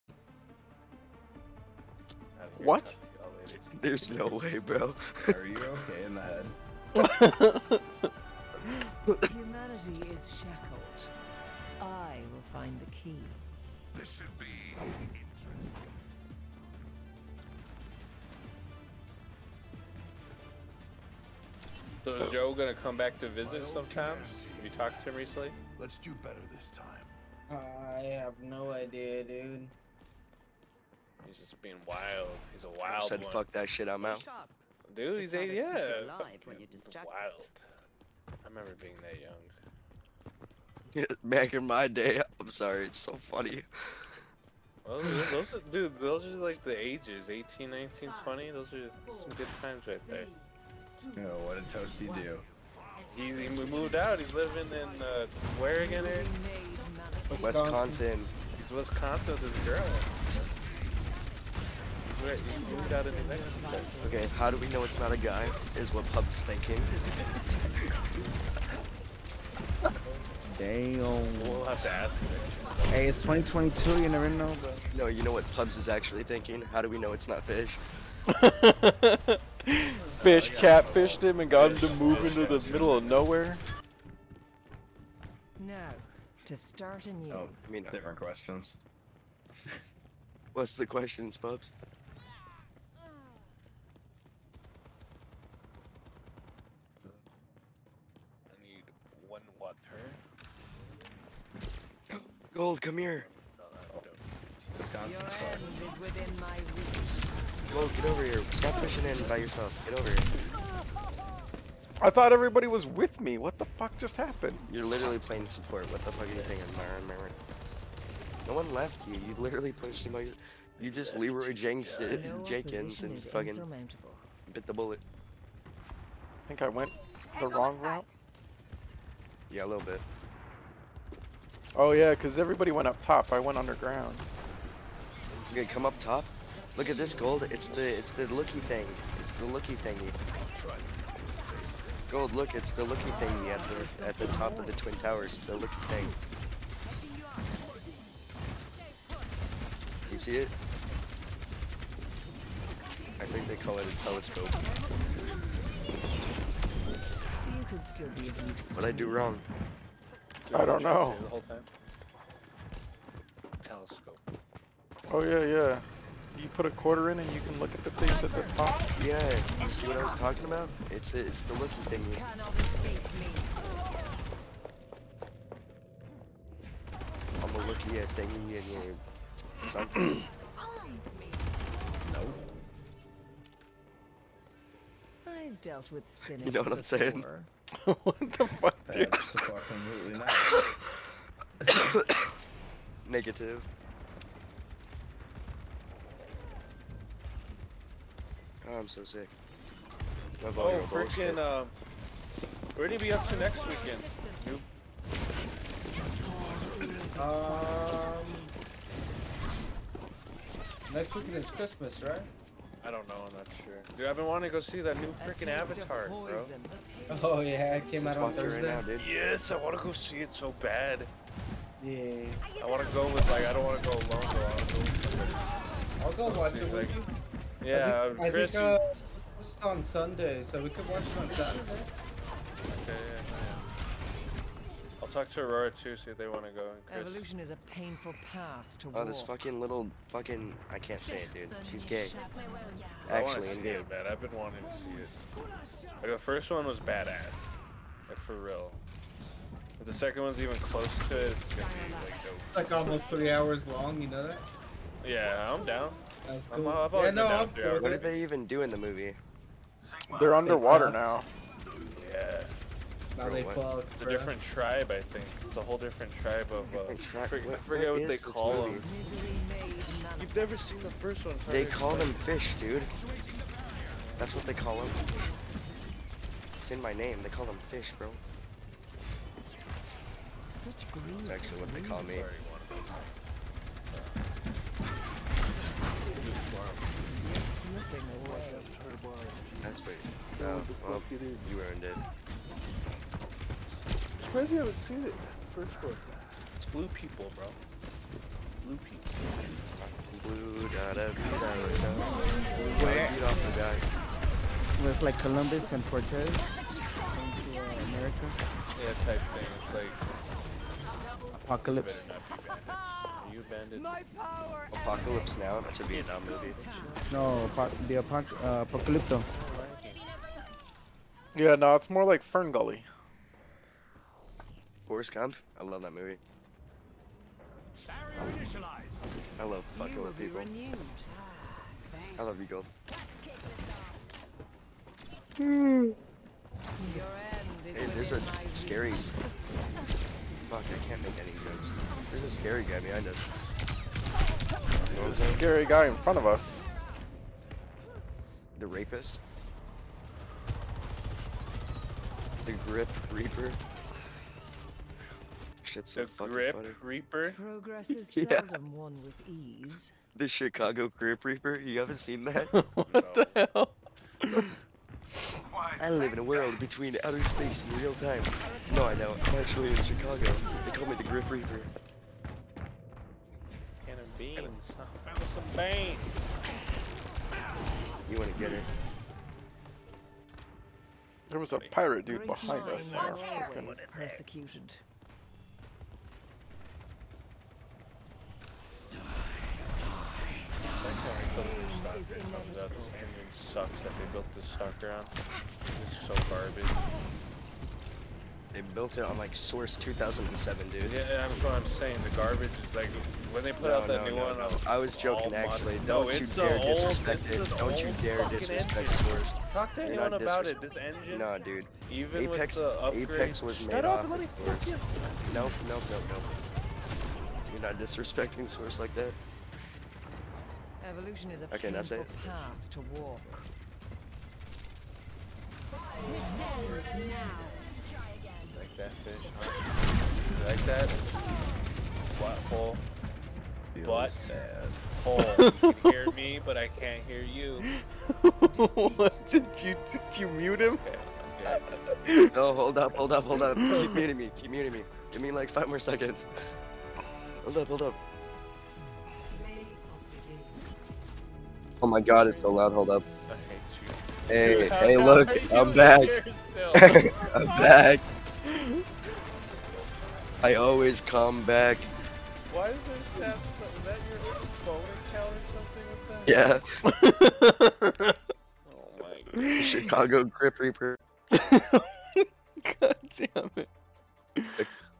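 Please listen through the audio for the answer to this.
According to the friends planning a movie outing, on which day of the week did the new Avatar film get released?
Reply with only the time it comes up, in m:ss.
3:38.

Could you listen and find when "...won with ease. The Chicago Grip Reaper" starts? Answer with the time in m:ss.
5:58.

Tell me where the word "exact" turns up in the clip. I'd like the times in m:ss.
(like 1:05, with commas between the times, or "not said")
not said.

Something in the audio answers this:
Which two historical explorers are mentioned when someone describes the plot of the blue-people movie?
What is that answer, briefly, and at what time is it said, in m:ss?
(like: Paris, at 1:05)
Columbus and Cortez, at 5:05.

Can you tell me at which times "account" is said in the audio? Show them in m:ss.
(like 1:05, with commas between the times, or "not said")
7:46.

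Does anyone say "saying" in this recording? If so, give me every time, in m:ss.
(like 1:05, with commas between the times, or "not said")
3:06, 6:41.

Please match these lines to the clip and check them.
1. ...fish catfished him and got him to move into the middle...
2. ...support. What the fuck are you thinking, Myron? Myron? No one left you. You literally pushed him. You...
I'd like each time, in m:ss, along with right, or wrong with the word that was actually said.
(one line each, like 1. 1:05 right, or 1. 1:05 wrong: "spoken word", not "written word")
1. 1:20 right
2. 1:55 right.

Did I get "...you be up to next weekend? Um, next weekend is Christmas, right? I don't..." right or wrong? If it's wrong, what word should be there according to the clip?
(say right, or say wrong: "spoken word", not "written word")
right.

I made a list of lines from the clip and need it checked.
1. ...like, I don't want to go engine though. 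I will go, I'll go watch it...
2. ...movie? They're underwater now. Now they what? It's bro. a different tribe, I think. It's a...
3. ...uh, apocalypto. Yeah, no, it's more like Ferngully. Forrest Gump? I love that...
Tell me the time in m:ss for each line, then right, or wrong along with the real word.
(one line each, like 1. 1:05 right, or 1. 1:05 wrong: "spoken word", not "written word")
1. 3:43 wrong: "alone", not "engine"
2. 4:18 right
3. 5:18 right.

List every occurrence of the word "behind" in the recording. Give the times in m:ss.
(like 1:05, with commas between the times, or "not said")
5:42, 6:22.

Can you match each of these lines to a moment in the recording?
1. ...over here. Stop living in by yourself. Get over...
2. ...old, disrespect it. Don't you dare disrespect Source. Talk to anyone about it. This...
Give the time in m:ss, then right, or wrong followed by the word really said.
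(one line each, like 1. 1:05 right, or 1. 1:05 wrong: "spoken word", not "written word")
1. 1:48 wrong: "pushing", not "living"
2. 6:46 right.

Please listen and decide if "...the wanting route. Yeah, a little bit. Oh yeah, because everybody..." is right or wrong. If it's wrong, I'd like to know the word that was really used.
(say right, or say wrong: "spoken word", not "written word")
wrong: "wrong", not "wanting".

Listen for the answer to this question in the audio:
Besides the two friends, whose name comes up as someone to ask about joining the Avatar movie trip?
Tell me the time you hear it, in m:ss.
3:55.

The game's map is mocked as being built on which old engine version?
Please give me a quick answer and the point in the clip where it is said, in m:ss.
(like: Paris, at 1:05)
Source 2007, at 6:39.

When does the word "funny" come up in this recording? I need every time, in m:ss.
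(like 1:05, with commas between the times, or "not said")
0:43, 5:56.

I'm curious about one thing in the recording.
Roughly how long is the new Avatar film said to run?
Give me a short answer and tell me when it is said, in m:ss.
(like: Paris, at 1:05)
Almost 3 hours, at 4:12.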